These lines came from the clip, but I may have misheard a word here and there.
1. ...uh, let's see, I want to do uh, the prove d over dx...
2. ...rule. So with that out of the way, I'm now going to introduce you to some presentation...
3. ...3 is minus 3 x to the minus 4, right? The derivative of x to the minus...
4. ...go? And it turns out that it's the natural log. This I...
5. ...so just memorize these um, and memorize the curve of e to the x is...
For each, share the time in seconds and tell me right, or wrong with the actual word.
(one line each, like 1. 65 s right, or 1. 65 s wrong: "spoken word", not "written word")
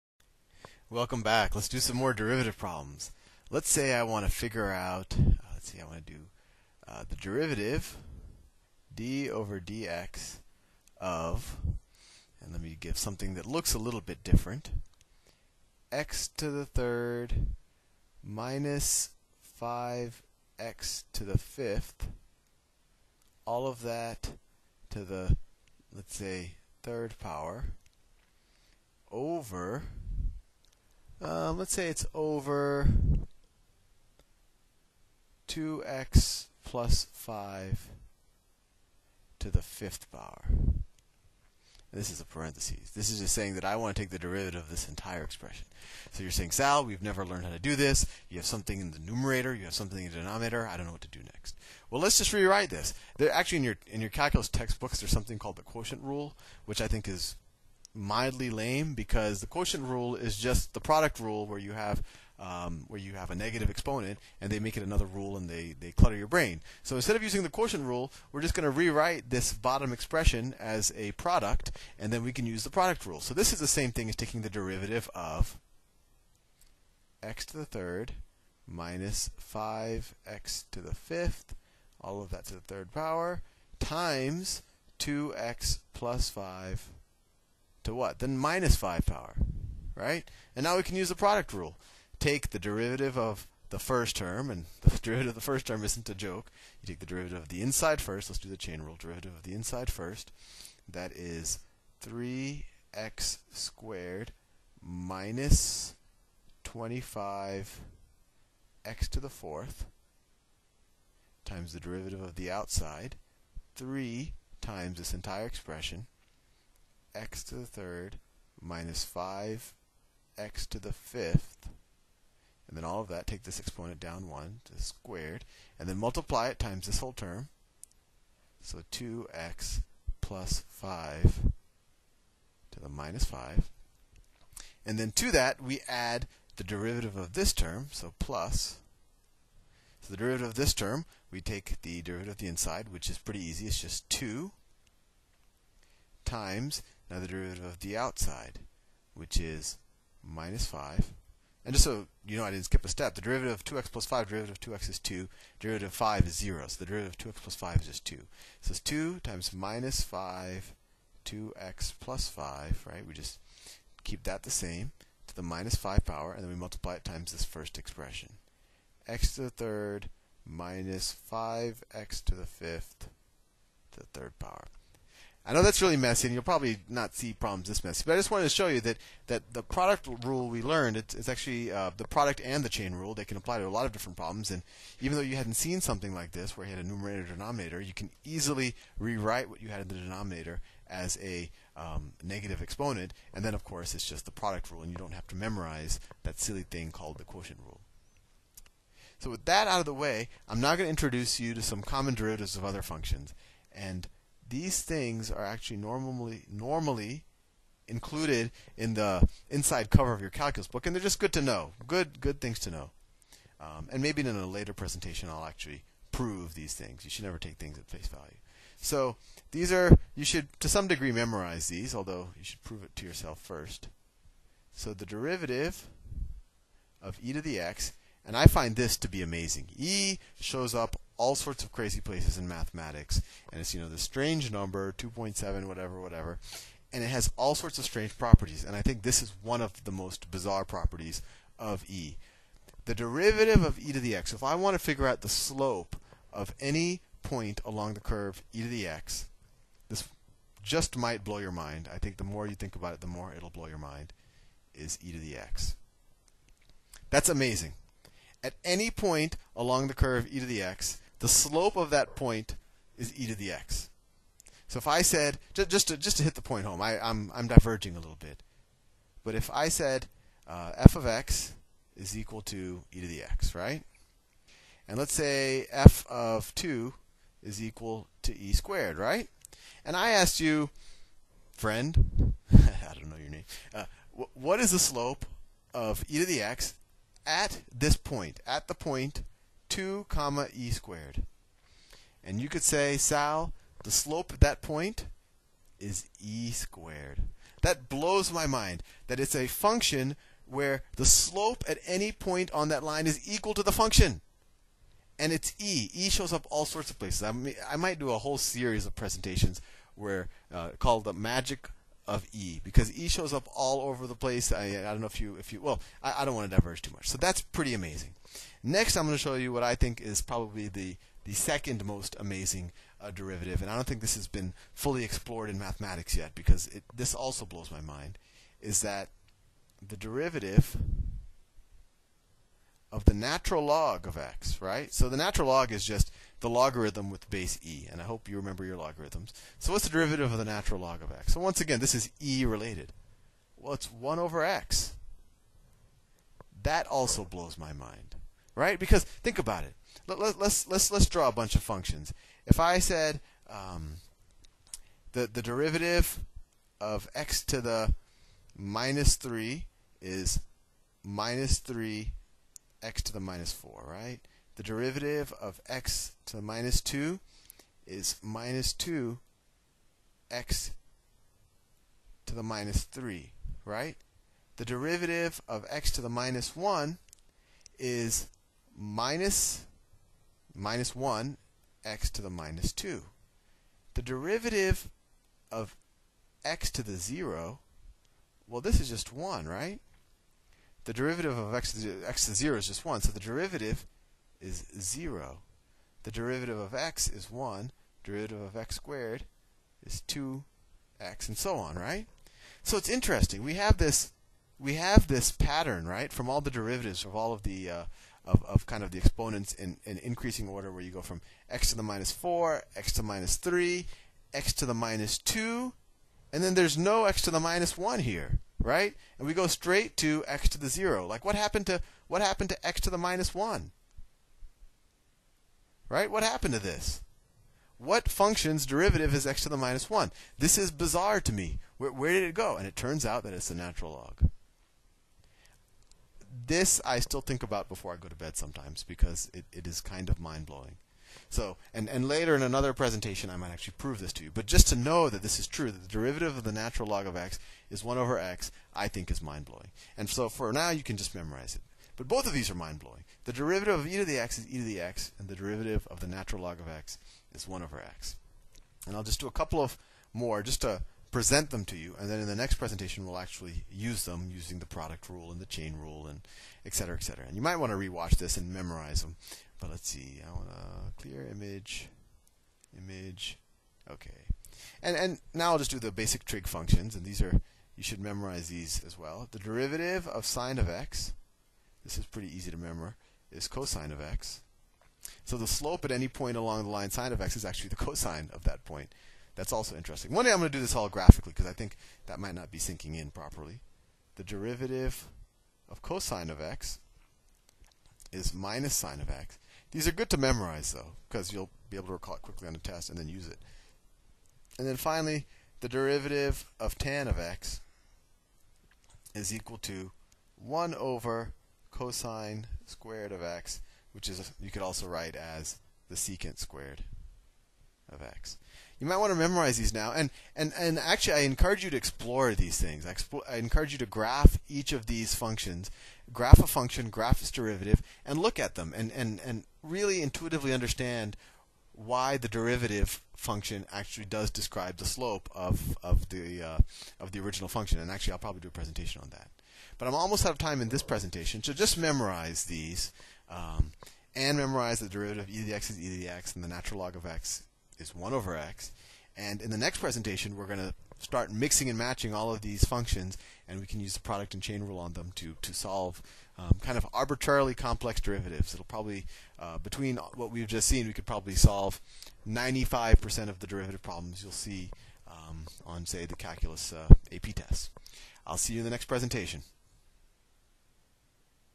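1. 5 s wrong: "derivative", not "prove"
2. 197 s wrong: "common", not "presentation"
3. 359 s right
4. 432 s right
5. 541 s wrong: "derivative", not "curve".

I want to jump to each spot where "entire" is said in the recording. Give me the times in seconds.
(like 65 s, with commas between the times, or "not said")
44 s, 115 s.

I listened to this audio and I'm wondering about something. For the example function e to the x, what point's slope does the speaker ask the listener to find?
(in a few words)
2, e squared.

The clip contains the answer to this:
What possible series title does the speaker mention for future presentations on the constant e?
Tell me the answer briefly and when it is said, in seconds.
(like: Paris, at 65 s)
the magic of E, at 311 s.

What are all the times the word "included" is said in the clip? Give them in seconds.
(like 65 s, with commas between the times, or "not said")
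207 s.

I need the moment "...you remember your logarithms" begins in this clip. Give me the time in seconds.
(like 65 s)
338 s.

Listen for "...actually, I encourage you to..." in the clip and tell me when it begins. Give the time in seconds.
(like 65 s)
520 s.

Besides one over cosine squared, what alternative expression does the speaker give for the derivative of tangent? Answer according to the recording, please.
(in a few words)
secant squared of x.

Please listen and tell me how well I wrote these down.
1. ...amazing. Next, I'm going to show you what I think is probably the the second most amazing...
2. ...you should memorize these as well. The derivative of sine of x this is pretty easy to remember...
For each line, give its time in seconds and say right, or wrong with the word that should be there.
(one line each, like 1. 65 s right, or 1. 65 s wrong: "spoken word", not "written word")
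1. 317 s right
2. 477 s right.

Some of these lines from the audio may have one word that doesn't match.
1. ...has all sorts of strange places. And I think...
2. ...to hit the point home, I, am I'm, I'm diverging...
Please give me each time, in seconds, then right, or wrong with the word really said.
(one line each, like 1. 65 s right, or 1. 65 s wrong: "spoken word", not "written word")
1. 237 s wrong: "properties", not "places"
2. 266 s right.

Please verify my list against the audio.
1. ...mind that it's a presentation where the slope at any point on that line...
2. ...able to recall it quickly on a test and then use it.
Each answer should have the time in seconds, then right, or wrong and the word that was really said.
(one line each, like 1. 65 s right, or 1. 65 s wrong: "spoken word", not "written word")
1. 298 s wrong: "function", not "presentation"
2. 501 s right.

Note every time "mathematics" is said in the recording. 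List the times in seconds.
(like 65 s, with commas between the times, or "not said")
232 s, 325 s.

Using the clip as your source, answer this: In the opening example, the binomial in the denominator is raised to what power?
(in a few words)
fifth power.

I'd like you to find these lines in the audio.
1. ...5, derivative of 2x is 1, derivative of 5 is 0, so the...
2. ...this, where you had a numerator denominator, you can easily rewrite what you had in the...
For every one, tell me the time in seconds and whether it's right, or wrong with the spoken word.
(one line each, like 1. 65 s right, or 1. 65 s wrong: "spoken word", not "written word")
1. 154 s wrong: "2", not "1"
2. 186 s right.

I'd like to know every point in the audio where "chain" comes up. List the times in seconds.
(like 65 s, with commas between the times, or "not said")
98 s, 182 s, 465 s, 554 s.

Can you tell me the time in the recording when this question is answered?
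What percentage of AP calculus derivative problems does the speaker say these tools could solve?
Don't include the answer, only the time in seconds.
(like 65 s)
562 s.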